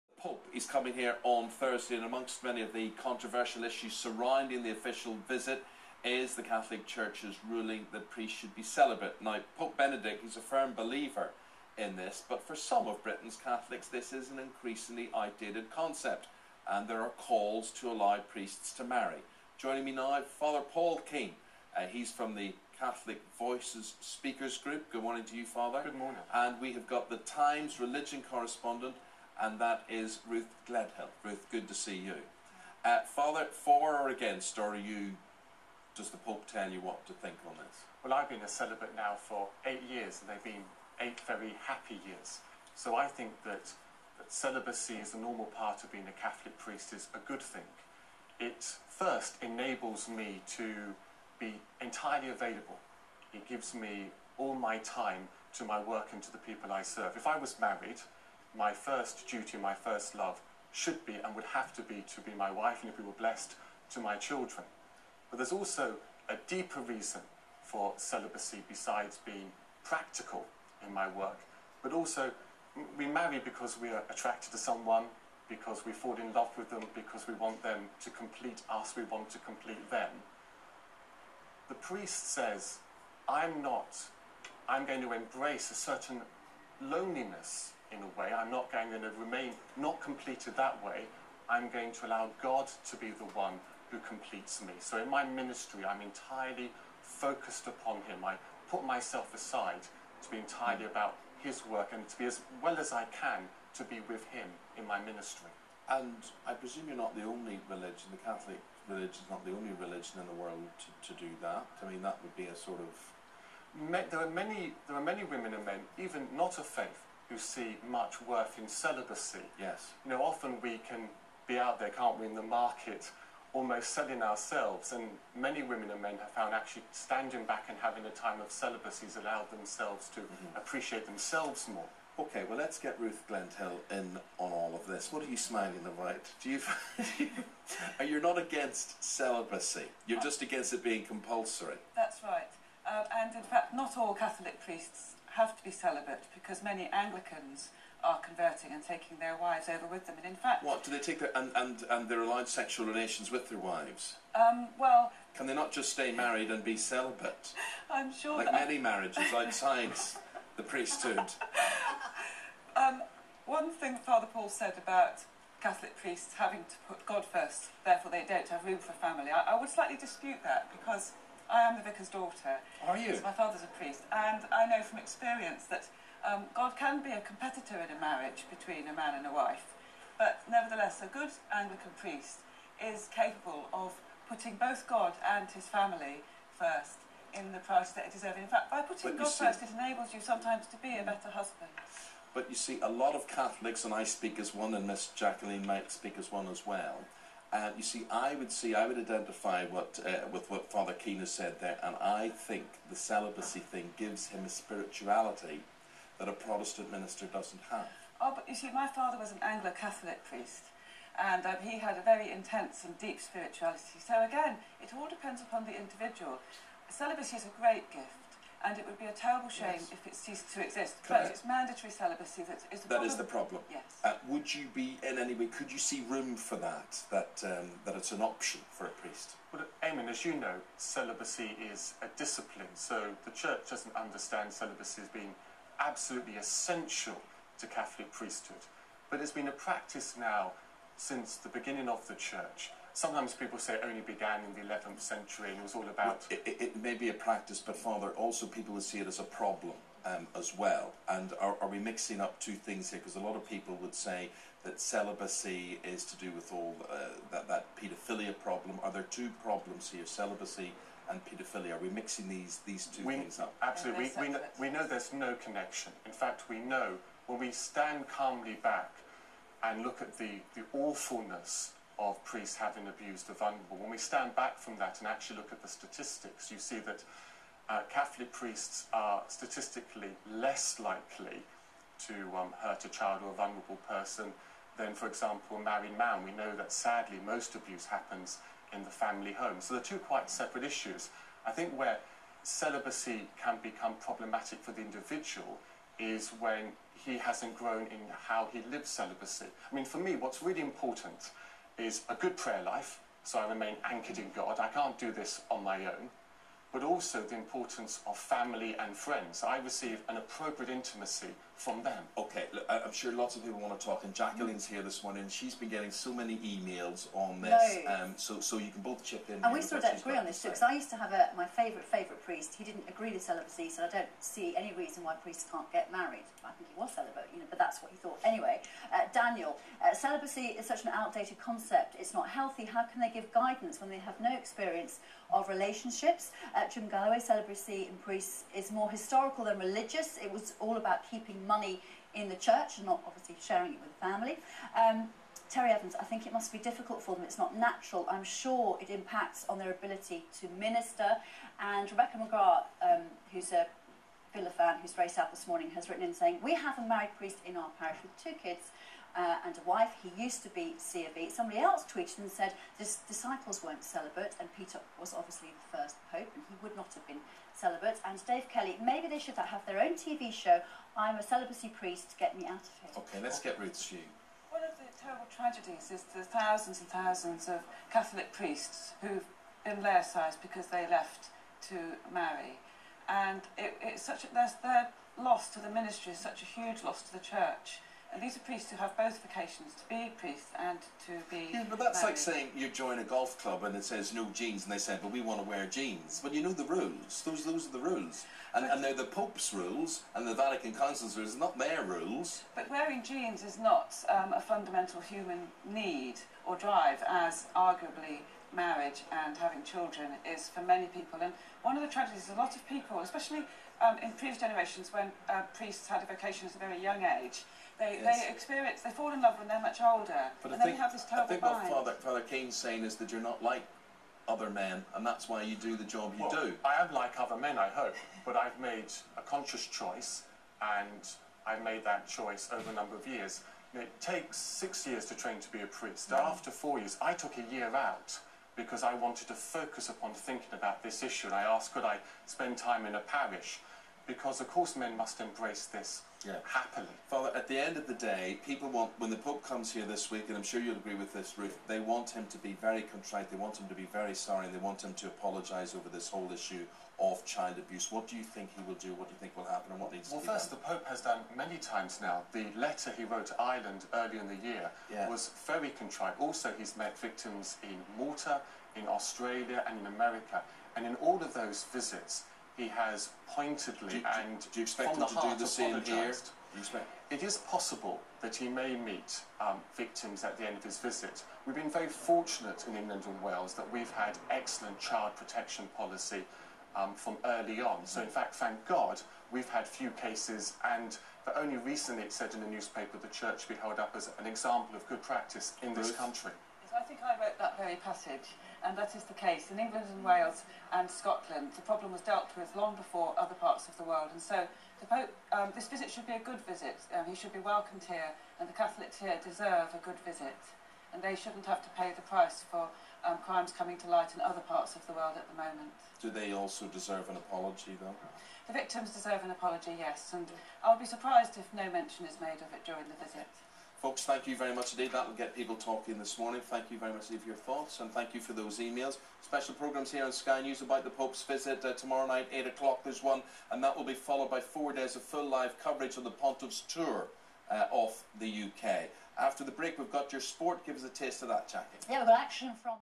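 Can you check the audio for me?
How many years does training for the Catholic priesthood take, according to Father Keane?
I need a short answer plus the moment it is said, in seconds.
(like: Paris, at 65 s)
6, at 434 s.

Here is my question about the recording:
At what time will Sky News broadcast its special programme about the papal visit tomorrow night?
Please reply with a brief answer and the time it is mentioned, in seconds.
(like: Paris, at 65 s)
8 o'clock, at 532 s.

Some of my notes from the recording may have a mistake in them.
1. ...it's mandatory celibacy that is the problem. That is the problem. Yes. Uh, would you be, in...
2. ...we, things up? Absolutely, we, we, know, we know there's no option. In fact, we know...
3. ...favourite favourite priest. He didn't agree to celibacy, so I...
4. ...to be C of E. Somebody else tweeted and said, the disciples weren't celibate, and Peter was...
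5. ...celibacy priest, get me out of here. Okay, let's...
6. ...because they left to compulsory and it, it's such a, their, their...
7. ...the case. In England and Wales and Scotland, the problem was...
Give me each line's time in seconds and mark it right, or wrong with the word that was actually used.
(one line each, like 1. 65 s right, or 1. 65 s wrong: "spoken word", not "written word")
1. 221 s right
2. 263 s wrong: "connection", not "option"
3. 321 s right
4. 360 s right
5. 371 s right
6. 380 s wrong: "marry", not "compulsory"
7. 499 s right.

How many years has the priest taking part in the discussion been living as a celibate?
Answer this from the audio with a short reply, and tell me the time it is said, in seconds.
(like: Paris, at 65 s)
8, at 39 s.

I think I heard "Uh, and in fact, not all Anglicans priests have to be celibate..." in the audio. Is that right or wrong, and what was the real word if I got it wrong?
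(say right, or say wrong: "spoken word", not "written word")
wrong: "Catholic", not "Anglicans".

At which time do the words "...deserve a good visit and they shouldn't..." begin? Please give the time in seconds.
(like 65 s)
509 s.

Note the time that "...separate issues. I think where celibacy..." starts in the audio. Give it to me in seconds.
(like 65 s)
290 s.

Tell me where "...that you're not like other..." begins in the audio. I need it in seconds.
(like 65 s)
422 s.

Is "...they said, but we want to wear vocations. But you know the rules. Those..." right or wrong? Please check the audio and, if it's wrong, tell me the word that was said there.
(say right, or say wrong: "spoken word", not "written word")
wrong: "jeans", not "vocations".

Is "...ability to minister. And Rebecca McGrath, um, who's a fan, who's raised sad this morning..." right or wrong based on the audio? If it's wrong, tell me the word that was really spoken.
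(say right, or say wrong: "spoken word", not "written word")
right.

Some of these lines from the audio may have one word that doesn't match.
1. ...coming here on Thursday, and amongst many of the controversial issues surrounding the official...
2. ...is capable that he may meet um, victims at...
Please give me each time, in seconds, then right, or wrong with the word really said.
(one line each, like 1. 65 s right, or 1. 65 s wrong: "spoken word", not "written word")
1. 0 s right
2. 477 s wrong: "possible", not "capable".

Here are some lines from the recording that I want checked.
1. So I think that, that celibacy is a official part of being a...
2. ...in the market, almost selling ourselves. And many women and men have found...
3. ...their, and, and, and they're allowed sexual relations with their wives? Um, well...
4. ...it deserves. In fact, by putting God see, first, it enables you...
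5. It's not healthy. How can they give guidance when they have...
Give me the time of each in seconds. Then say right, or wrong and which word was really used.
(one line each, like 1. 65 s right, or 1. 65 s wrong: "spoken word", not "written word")
1. 42 s wrong: "normal", not "official"
2. 122 s right
3. 151 s right
4. 188 s right
5. 331 s right.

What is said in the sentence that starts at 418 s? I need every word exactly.
they experience, they fall in love when they're much older.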